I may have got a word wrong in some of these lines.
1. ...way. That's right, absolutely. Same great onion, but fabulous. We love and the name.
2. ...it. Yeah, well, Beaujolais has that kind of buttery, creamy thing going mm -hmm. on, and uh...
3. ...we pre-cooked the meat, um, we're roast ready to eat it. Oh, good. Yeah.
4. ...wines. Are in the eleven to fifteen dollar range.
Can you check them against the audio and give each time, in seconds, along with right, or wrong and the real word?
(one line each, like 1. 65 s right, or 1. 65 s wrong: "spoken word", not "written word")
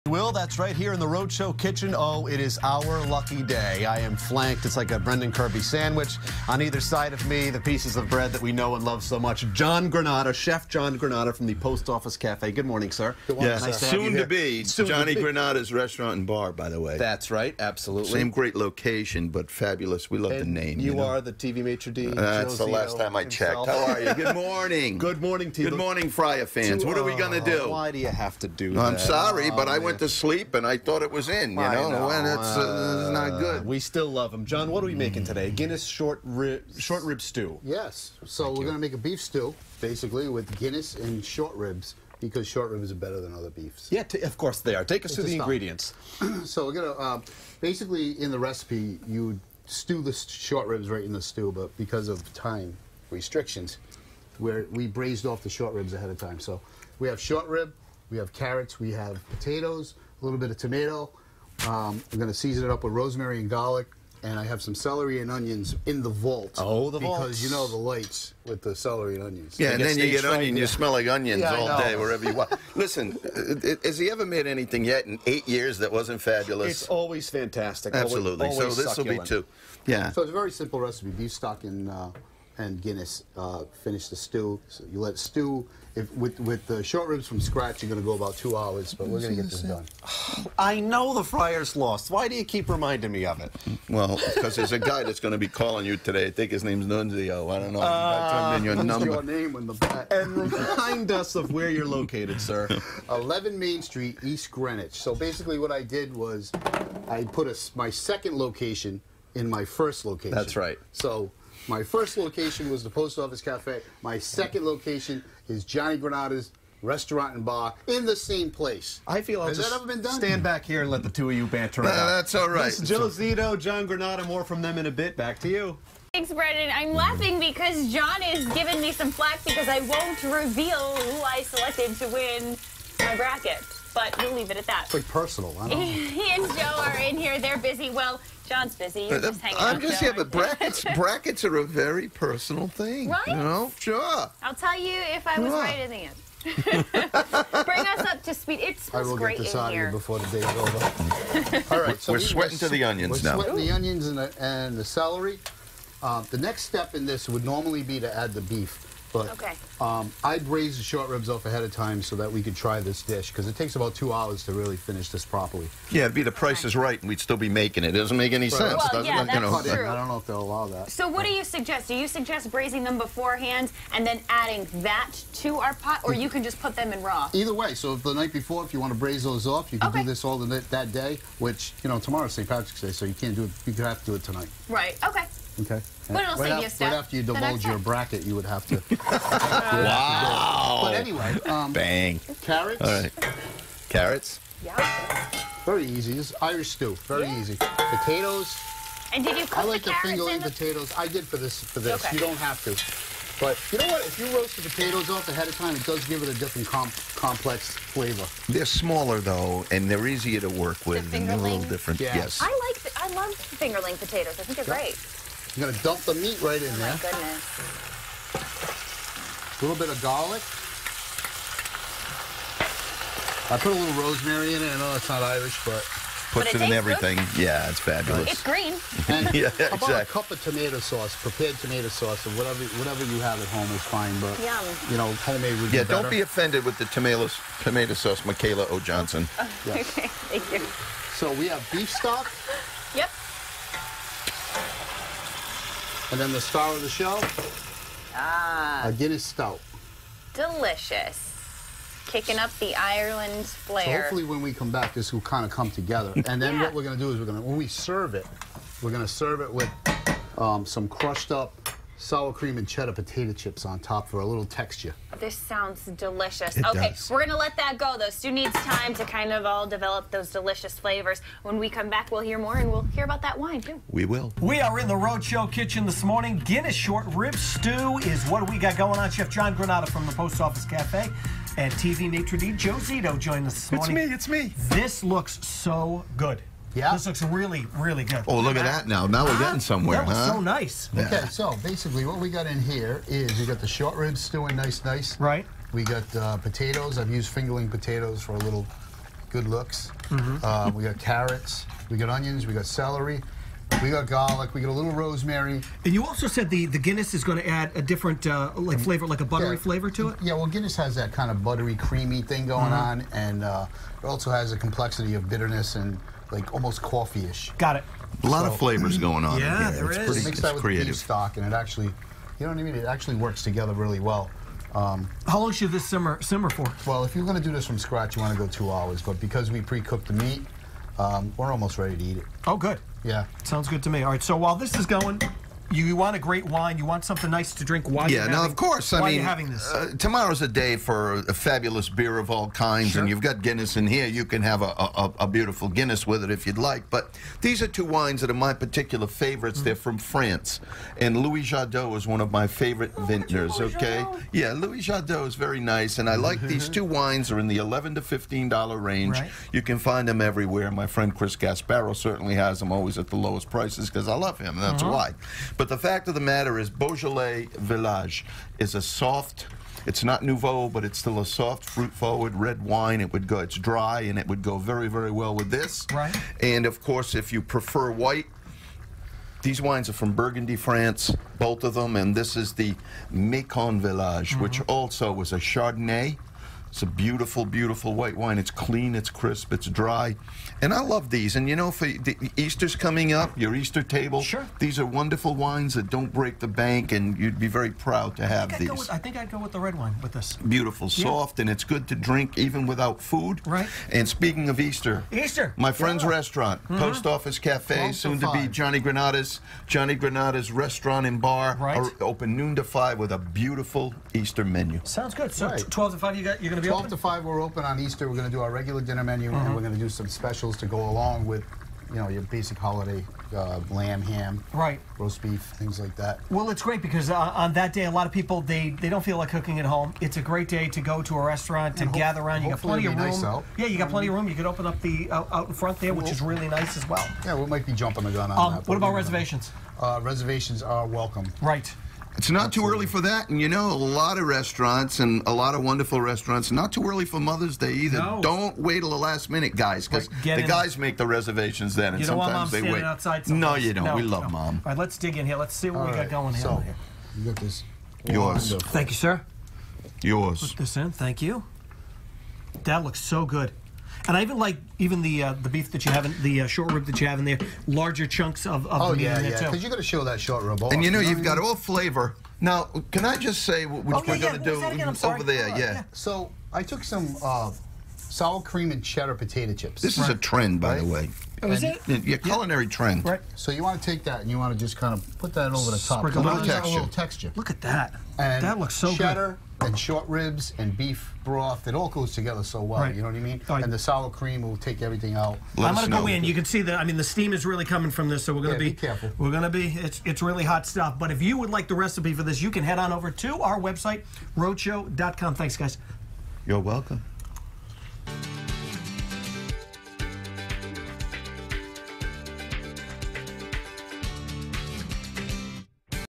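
1. 16 s wrong: "location", not "onion"
2. 310 s wrong: "Guinness", not "Beaujolais"
3. 329 s wrong: "almost", not "roast"
4. 356 s right.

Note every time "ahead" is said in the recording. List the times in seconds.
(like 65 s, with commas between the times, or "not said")
55 s, 161 s, 205 s.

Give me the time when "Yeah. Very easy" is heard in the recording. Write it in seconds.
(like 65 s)
194 s.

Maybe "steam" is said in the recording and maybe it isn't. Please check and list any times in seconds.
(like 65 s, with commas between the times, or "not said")
497 s.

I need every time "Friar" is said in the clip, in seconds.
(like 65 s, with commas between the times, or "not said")
26 s, 91 s.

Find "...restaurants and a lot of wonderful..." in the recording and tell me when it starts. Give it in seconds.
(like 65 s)
444 s.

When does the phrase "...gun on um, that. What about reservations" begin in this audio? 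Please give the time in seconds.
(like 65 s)
438 s.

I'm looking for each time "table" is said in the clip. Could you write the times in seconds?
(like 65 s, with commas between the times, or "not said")
393 s.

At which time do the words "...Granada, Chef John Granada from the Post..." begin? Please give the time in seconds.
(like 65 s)
9 s.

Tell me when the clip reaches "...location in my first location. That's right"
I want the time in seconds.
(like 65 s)
108 s.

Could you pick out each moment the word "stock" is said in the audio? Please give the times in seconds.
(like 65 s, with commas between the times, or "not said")
81 s, 241 s, 320 s.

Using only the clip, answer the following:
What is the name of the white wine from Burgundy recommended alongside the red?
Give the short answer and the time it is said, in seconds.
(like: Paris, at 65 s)
Mâcon Village, at 383 s.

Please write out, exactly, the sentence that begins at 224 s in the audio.
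I know that's not Irish, but puts it, it in everything.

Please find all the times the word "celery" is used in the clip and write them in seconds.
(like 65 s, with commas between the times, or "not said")
64 s, 68 s, 154 s, 302 s.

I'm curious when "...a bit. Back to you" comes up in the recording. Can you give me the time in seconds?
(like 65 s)
124 s.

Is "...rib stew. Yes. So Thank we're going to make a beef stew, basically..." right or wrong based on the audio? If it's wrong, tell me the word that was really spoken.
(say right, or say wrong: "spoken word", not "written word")
right.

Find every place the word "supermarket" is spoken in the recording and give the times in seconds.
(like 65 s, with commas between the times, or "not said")
not said.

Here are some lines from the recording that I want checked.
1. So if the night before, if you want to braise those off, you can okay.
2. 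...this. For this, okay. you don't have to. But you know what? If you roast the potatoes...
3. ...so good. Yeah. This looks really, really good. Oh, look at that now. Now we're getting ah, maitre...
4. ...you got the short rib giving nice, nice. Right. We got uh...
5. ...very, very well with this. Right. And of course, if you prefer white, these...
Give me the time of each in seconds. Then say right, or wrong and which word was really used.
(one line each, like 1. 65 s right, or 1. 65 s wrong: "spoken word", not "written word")
1. 177 s right
2. 201 s right
3. 285 s wrong: "somewhere", not "maitre"
4. 293 s wrong: "stewing", not "giving"
5. 374 s right.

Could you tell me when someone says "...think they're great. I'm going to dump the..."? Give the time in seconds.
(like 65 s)
214 s.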